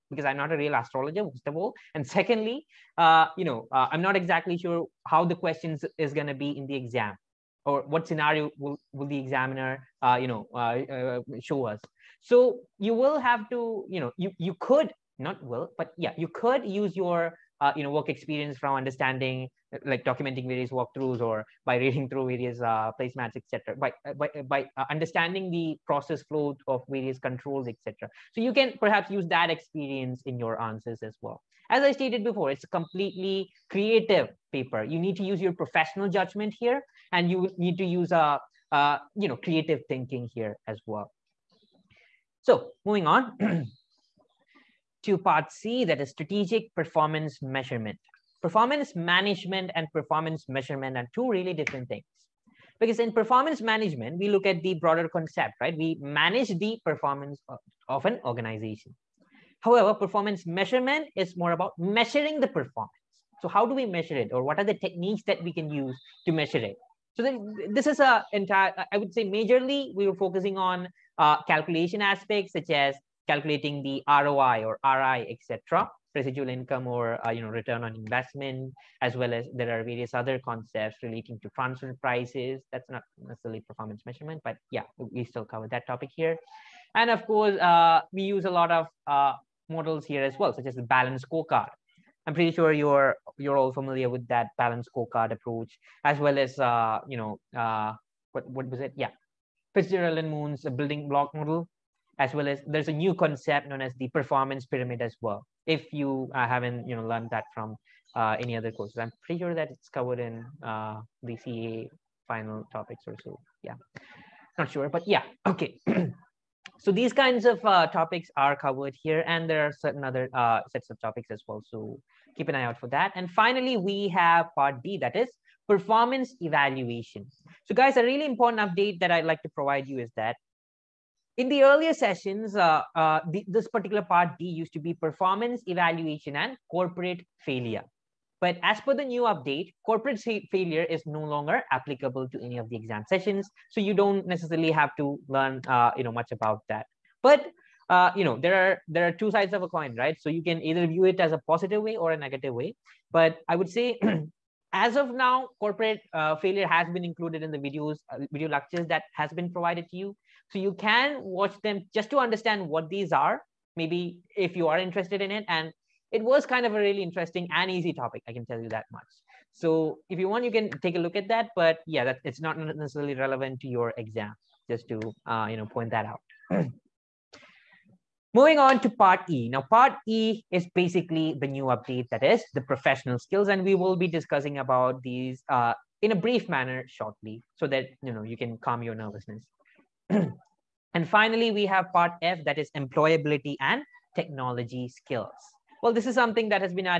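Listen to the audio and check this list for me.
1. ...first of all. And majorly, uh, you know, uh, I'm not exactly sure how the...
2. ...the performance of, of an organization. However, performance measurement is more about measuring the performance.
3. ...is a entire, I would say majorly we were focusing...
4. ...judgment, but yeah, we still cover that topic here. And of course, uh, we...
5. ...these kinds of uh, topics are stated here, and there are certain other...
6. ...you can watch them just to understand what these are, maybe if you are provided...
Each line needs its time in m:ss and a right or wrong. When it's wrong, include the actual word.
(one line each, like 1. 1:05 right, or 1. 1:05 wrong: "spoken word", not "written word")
1. 0:01 wrong: "secondly", not "majorly"
2. 0:56 right
3. 1:07 right
4. 1:24 wrong: "measurement", not "judgment"
5. 1:56 wrong: "covered", not "stated"
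6. 2:40 wrong: "interested", not "provided".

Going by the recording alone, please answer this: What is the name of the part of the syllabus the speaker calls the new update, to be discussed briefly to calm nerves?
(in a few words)
Professional skills.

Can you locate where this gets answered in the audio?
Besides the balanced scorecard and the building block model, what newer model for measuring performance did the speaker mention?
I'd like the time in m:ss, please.
1:44.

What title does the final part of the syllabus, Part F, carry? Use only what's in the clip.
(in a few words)
Employability and technology skills.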